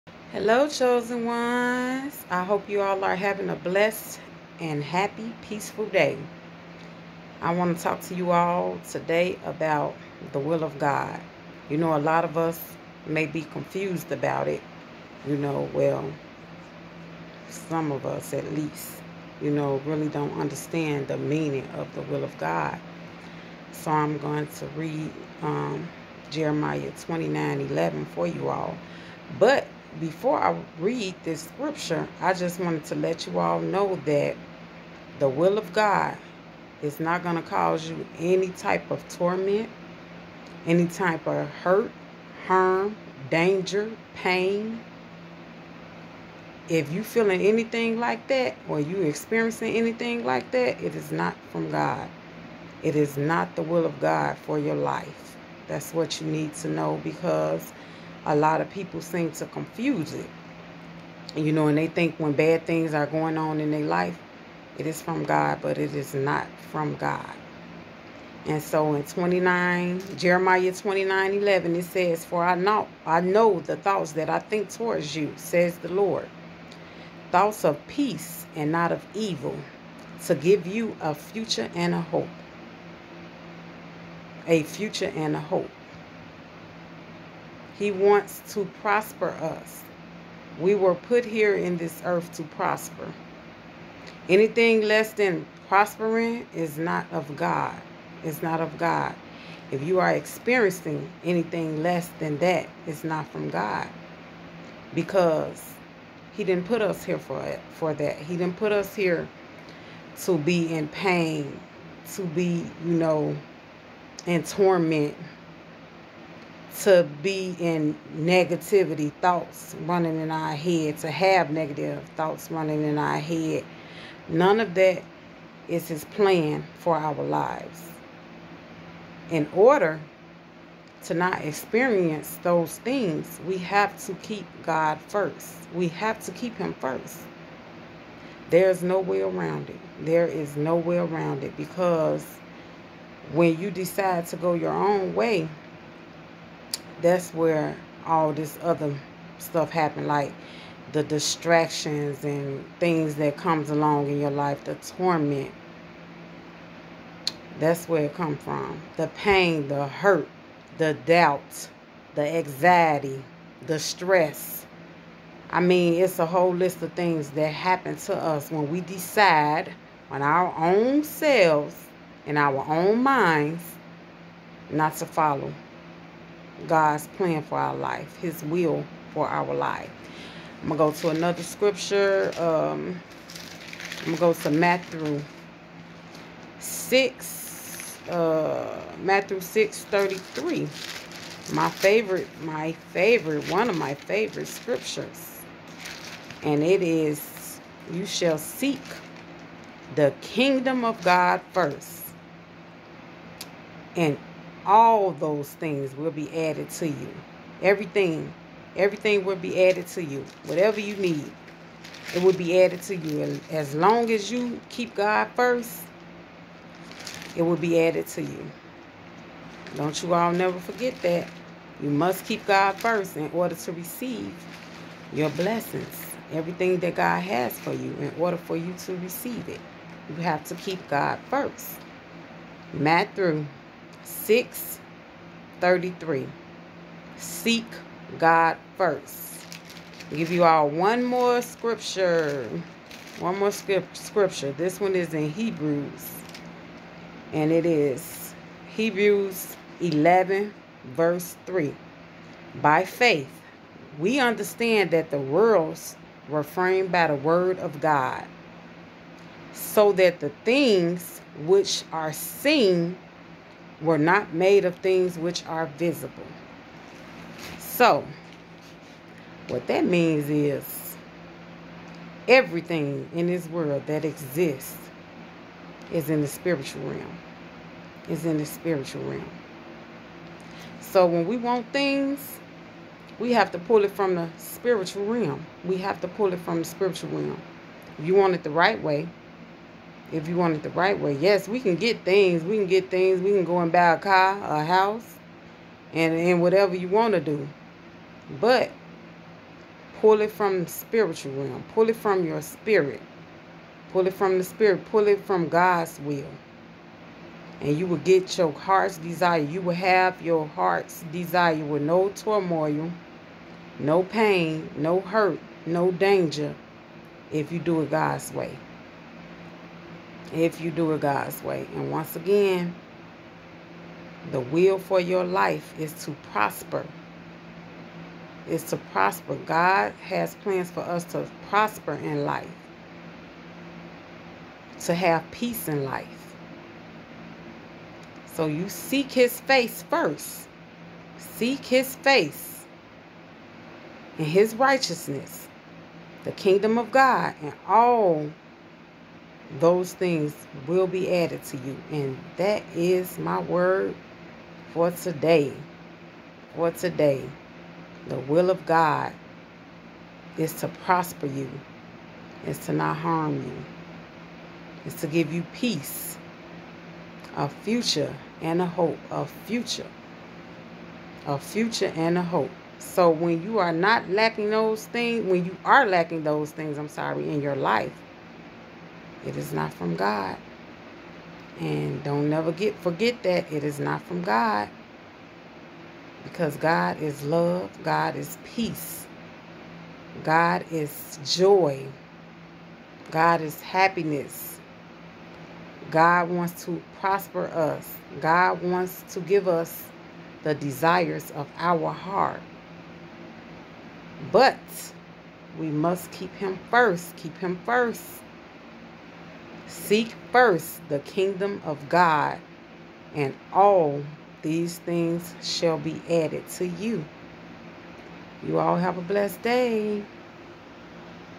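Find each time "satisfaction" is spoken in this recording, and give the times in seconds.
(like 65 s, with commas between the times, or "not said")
not said.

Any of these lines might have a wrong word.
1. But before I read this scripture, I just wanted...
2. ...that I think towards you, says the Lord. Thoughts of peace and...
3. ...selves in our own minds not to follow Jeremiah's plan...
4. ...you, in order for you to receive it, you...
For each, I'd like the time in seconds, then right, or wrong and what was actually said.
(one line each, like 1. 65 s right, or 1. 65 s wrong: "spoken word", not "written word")
1. 29 s right
2. 74 s right
3. 171 s wrong: "God", not "Jeremiah"
4. 227 s right.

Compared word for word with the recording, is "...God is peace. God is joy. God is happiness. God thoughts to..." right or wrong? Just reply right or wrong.
wrong.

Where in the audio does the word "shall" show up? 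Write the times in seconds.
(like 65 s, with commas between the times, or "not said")
198 s, 415 s.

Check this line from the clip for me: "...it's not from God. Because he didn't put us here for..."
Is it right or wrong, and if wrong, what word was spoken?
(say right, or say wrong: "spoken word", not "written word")
right.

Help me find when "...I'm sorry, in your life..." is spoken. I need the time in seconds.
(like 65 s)
376 s.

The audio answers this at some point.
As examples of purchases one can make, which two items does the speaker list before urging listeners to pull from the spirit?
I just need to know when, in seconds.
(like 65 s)
293 s.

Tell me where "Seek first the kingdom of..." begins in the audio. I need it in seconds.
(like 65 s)
409 s.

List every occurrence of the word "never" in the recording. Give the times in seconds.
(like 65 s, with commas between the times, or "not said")
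220 s, 382 s.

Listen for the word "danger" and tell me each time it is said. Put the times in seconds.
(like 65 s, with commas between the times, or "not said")
43 s, 315 s.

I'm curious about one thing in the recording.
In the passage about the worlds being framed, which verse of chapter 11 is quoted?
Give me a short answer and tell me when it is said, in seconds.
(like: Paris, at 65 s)
verse 3, at 250 s.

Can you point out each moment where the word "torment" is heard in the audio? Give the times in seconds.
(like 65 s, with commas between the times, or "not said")
39 s, 114 s, 154 s.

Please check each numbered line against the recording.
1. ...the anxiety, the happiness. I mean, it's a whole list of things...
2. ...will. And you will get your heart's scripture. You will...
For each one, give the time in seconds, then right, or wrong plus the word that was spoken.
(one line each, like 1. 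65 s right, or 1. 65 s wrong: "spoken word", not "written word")
1. 162 s wrong: "stress", not "happiness"
2. 306 s wrong: "desire", not "scripture".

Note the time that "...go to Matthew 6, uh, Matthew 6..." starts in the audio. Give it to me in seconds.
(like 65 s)
184 s.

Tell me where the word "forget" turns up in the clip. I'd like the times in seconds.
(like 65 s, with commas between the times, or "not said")
220 s, 382 s.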